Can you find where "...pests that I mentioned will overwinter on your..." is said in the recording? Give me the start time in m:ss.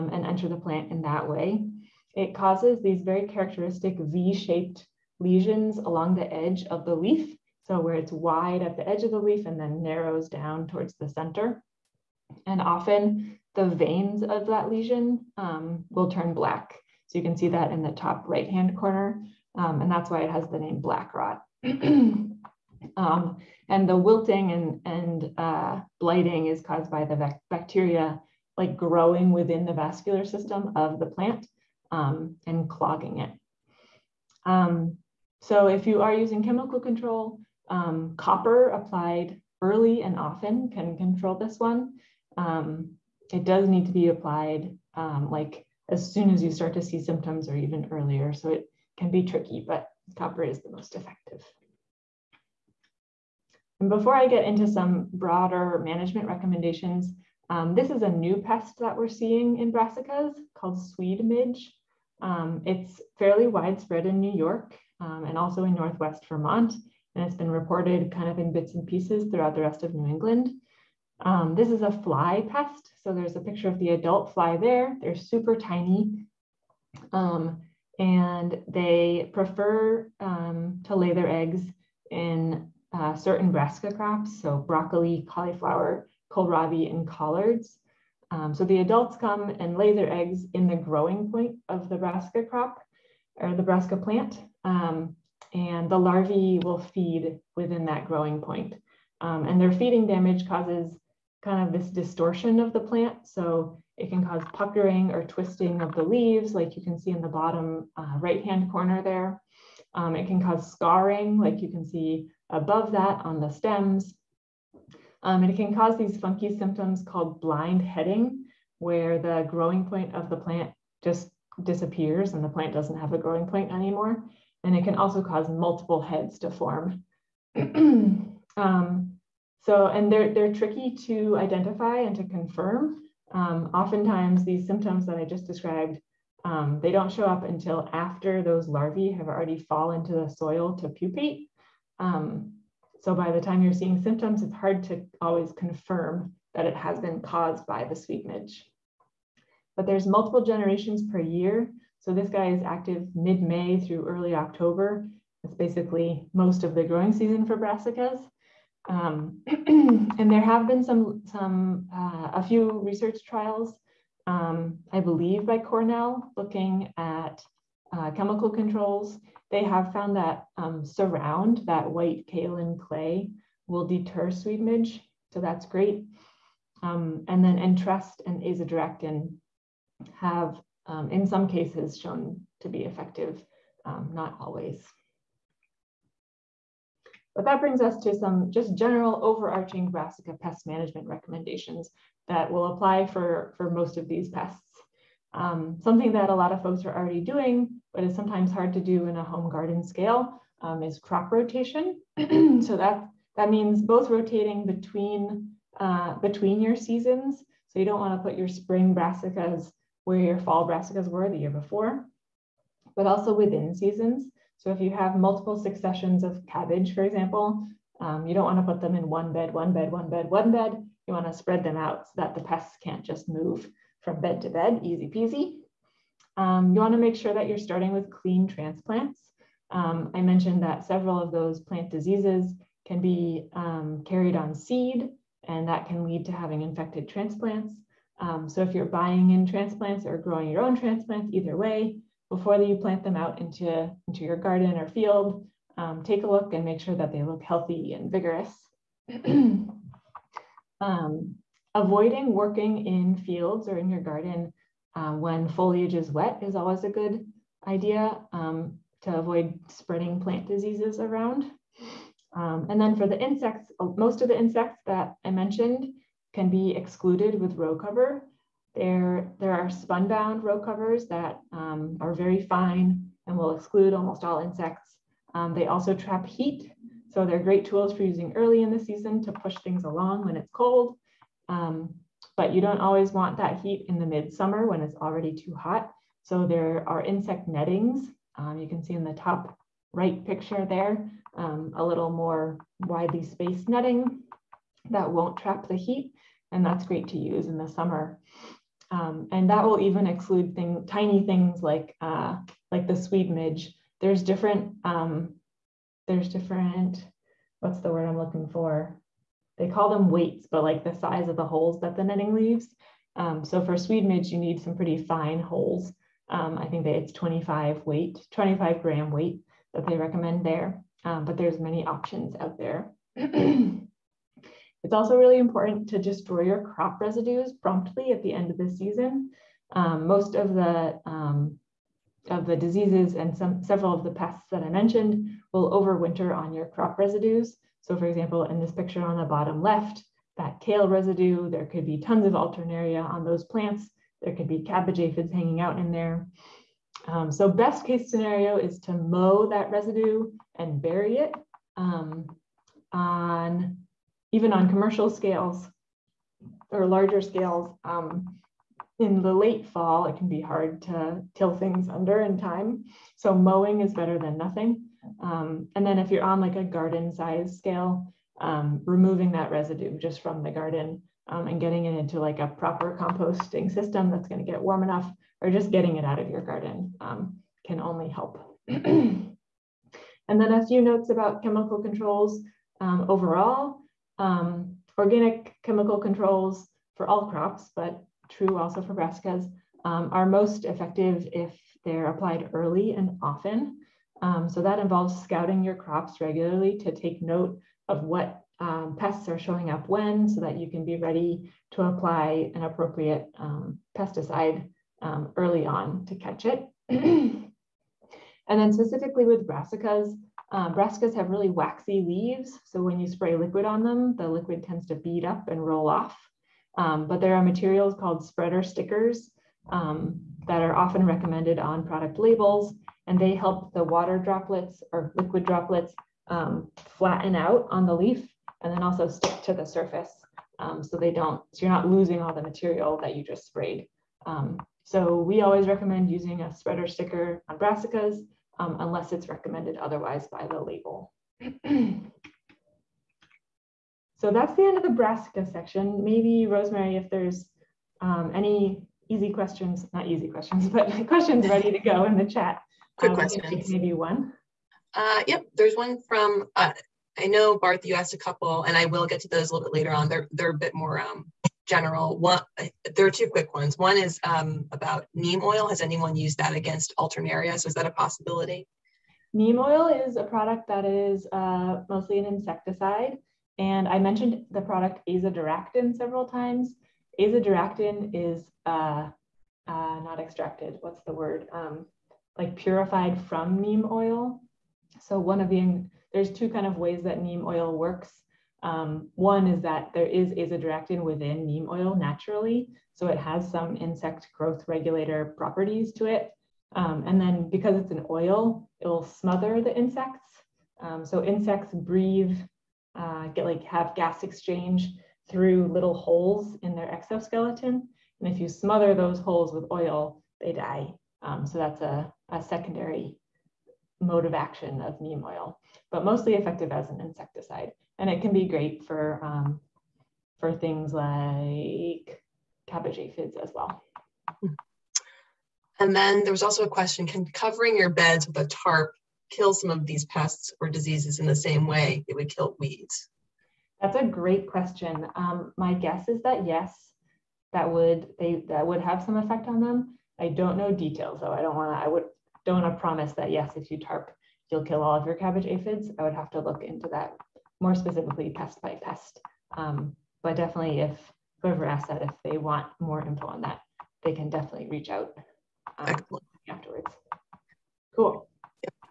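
5:34.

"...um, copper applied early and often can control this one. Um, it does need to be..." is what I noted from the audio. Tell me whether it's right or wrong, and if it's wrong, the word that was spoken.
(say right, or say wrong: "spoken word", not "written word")
right.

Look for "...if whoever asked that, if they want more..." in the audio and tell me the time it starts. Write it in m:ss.
9:10.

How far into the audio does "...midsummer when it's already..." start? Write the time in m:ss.
4:44.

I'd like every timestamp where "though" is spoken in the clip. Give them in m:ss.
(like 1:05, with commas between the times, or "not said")
9:01.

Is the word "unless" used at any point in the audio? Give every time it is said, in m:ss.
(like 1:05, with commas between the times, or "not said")
7:18.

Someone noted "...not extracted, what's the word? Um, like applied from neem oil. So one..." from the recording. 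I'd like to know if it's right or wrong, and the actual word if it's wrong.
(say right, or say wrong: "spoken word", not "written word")
wrong: "purified", not "applied".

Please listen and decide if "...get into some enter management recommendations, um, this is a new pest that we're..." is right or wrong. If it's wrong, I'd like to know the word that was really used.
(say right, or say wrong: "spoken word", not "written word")
wrong: "broader", not "enter".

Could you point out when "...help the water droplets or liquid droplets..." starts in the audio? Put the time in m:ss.
7:03.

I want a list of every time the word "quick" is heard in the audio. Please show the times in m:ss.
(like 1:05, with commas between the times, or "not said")
7:32, 7:43.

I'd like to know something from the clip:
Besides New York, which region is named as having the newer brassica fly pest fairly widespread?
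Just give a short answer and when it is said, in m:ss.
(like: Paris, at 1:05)
Northwest Vermont, at 1:05.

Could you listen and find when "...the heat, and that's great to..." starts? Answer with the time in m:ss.
4:55.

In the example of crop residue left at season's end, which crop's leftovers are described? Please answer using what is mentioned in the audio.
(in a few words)
Kale.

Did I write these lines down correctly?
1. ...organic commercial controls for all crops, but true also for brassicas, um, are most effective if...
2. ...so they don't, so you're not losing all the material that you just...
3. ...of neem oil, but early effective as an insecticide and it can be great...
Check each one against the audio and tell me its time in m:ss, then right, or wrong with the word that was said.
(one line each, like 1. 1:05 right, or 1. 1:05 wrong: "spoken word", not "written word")
1. 6:24 wrong: "chemical", not "commercial"
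2. 7:10 right
3. 8:34 wrong: "mostly", not "early".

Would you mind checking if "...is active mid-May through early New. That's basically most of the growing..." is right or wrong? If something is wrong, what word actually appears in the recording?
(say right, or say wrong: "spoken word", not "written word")
wrong: "October", not "New".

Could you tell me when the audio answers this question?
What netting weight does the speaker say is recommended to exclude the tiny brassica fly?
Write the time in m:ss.
5:18.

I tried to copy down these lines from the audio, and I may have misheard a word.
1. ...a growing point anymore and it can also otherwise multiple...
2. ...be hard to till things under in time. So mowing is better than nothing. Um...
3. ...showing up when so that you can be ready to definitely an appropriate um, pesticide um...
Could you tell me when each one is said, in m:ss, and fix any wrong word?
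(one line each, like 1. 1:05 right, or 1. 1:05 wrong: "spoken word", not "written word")
1. 2:03 wrong: "cause", not "otherwise"
2. 6:00 right
3. 6:39 wrong: "apply", not "definitely".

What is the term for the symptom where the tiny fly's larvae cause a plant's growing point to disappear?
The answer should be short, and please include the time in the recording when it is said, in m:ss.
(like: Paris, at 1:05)
Blind heading, at 1:57.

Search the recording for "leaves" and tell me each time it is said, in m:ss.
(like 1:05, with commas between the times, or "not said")
1:46, 5:12, 6:52.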